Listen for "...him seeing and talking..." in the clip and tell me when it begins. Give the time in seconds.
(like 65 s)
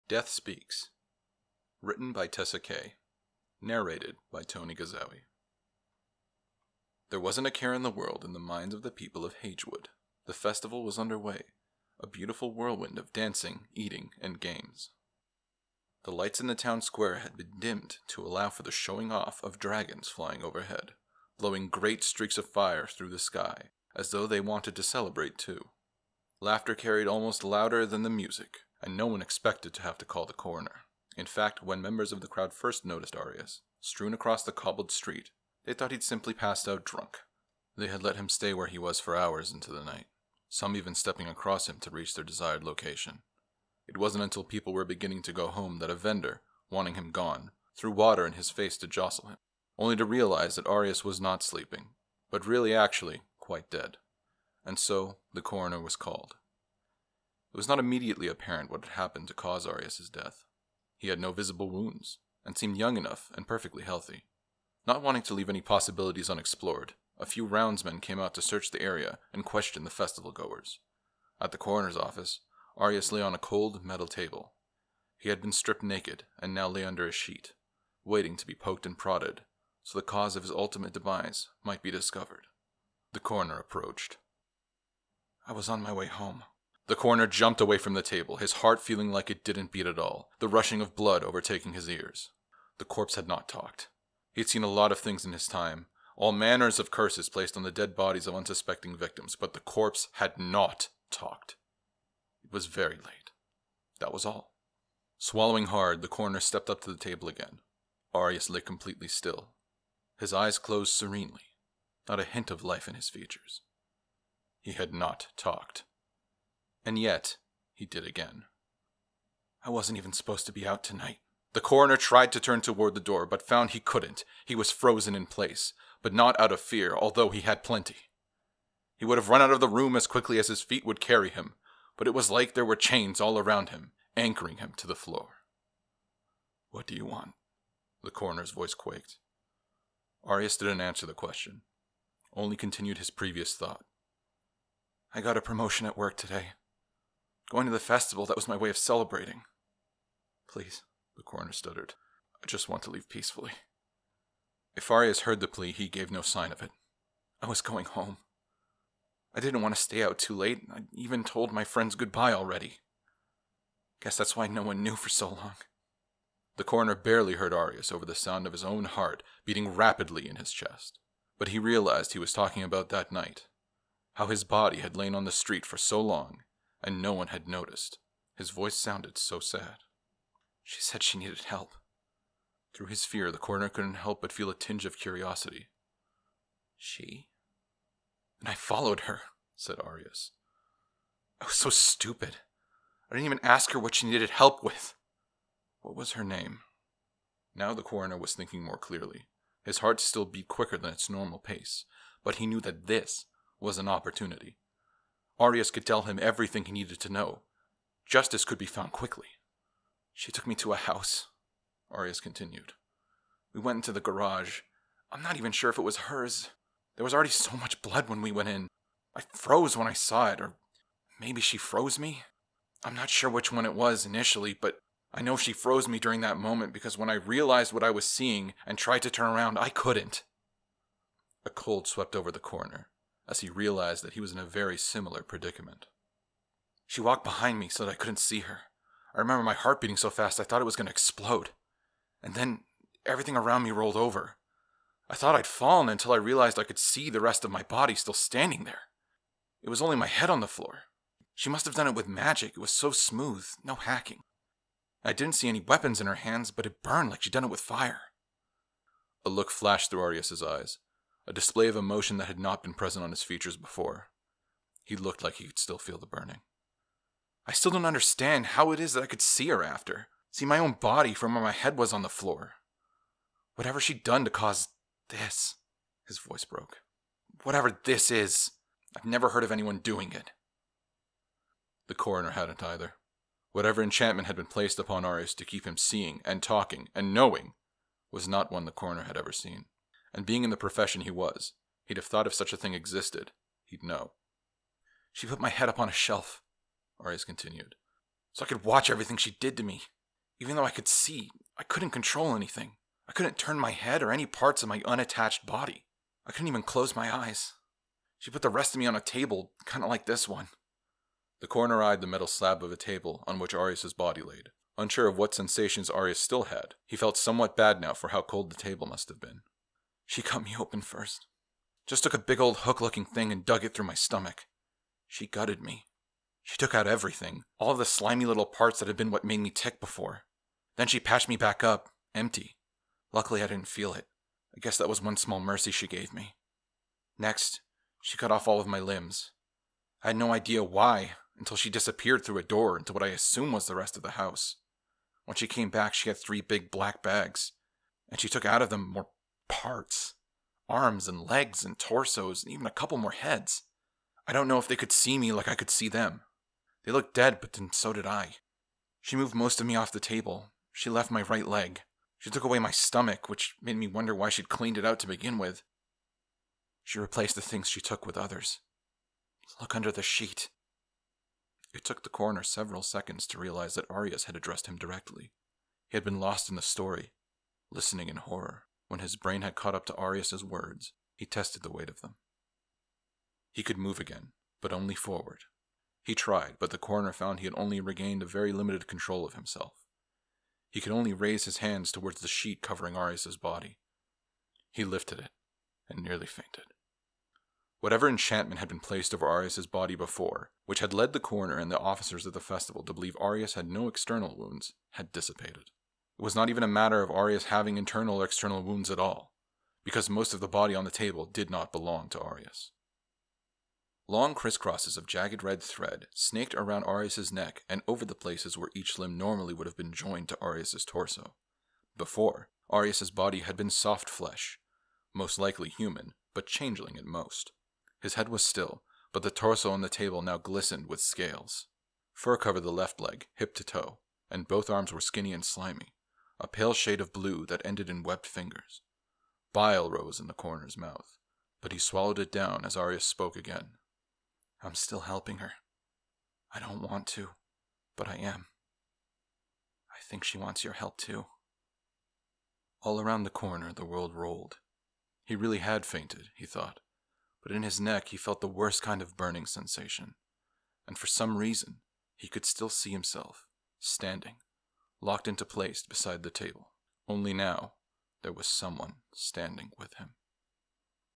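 285 s.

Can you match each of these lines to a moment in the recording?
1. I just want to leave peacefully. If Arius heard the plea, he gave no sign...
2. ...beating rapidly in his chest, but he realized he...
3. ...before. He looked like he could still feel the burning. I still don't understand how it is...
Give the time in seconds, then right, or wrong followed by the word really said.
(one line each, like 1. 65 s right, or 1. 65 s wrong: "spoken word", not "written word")
1. 152 s right
2. 169 s right
3. 263 s right.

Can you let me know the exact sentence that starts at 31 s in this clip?
In fact, when members of the crowd first noticed Arius strewn across the cobbled street, they thought he'd simply passed out drunk.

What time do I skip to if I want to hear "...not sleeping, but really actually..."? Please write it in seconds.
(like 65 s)
51 s.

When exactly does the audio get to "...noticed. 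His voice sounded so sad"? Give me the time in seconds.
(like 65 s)
177 s.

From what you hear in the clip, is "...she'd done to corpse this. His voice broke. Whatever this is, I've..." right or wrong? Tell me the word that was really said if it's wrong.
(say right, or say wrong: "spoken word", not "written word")
wrong: "cause", not "corpse".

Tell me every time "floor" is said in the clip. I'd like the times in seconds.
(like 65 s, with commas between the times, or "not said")
134 s, 250 s, 272 s.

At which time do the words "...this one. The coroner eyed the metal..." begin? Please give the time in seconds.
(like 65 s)
310 s.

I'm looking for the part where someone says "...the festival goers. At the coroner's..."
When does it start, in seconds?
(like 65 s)
69 s.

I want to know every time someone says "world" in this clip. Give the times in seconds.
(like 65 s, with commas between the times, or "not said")
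7 s, 453 s.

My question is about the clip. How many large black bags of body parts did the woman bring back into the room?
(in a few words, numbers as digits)
3.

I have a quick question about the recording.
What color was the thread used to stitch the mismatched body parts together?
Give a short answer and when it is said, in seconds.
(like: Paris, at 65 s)
Red, at 415 s.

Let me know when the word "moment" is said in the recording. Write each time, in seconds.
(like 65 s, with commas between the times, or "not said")
226 s.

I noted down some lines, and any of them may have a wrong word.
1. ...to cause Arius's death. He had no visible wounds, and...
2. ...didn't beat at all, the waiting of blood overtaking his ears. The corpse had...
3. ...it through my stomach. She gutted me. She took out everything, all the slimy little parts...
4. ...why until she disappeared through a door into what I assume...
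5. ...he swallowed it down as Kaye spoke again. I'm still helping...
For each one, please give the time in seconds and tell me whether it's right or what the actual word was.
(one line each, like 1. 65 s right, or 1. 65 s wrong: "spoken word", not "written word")
1. 59 s right
2. 89 s wrong: "rushing", not "waiting"
3. 323 s right
4. 340 s right
5. 441 s wrong: "Arius", not "Kaye".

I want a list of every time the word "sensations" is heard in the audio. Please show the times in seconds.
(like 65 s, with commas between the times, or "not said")
315 s, 459 s.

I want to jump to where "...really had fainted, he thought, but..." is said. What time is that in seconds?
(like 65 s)
455 s.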